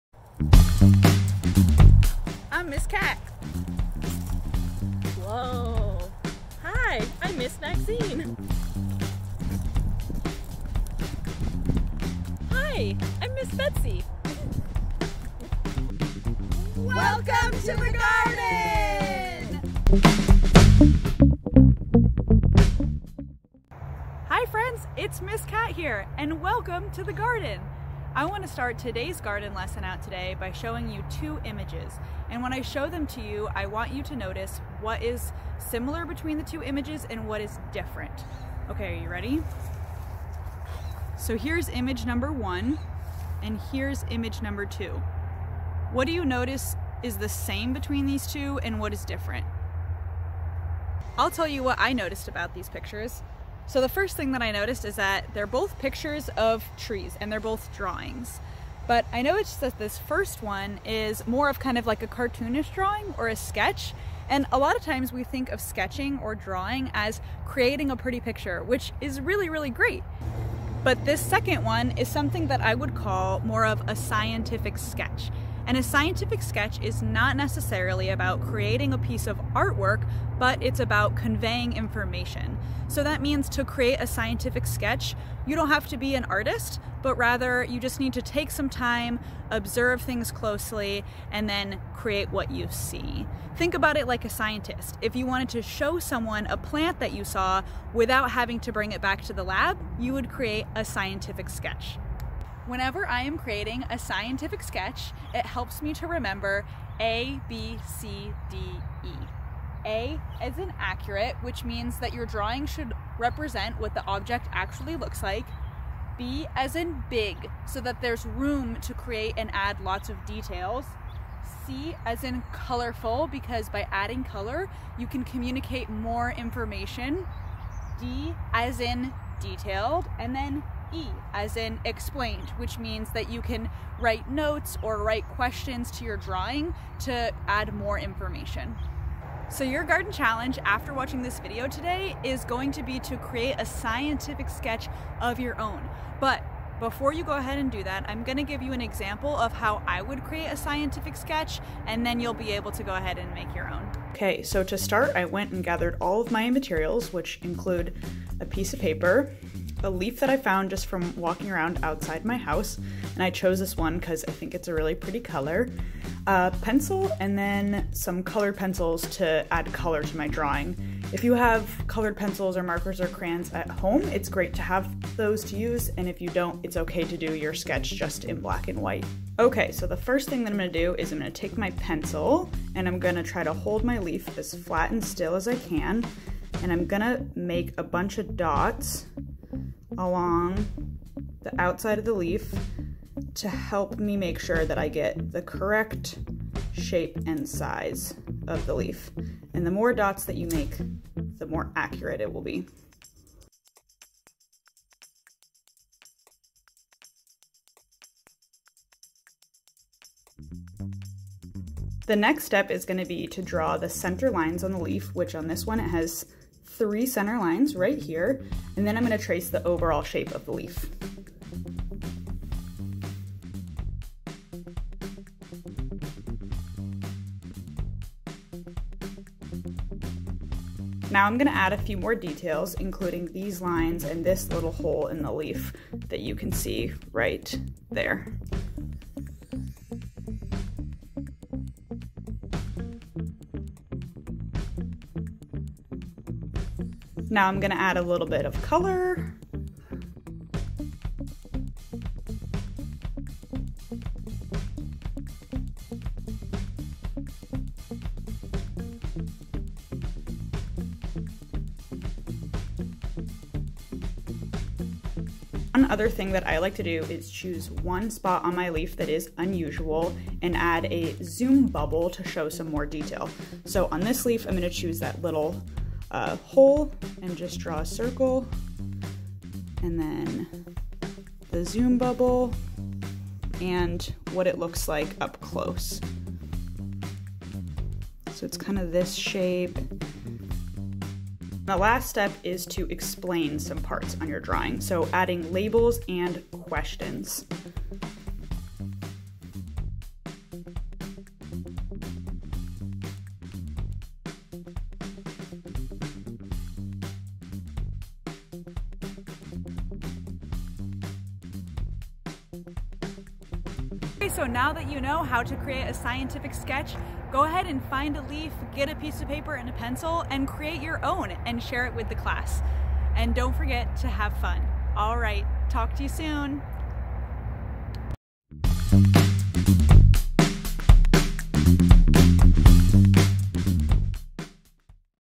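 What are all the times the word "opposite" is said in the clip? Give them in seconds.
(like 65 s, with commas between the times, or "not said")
not said.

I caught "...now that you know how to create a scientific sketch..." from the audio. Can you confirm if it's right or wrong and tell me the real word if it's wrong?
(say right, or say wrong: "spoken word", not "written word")
right.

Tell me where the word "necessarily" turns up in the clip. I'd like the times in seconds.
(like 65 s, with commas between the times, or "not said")
77 s.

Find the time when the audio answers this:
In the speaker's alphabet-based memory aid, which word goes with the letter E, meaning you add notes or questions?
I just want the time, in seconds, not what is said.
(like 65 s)
131 s.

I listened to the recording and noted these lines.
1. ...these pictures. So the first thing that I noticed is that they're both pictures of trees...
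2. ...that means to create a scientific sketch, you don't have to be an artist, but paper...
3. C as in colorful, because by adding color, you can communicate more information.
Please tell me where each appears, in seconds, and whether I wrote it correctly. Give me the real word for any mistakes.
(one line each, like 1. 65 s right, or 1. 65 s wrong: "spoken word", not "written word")
1. 52 s right
2. 83 s wrong: "rather", not "paper"
3. 121 s right.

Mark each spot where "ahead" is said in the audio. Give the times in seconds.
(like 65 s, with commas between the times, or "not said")
147 s, 152 s, 317 s.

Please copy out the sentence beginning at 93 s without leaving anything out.
Think about it like a scientist.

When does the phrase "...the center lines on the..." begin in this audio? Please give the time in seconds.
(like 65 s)
213 s.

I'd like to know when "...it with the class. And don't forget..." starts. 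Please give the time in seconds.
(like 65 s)
321 s.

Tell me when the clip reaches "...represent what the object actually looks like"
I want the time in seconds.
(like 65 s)
113 s.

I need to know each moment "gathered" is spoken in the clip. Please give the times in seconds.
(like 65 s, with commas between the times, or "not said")
155 s.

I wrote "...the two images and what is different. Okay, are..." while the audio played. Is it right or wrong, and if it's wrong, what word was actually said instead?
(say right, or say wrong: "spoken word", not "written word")
right.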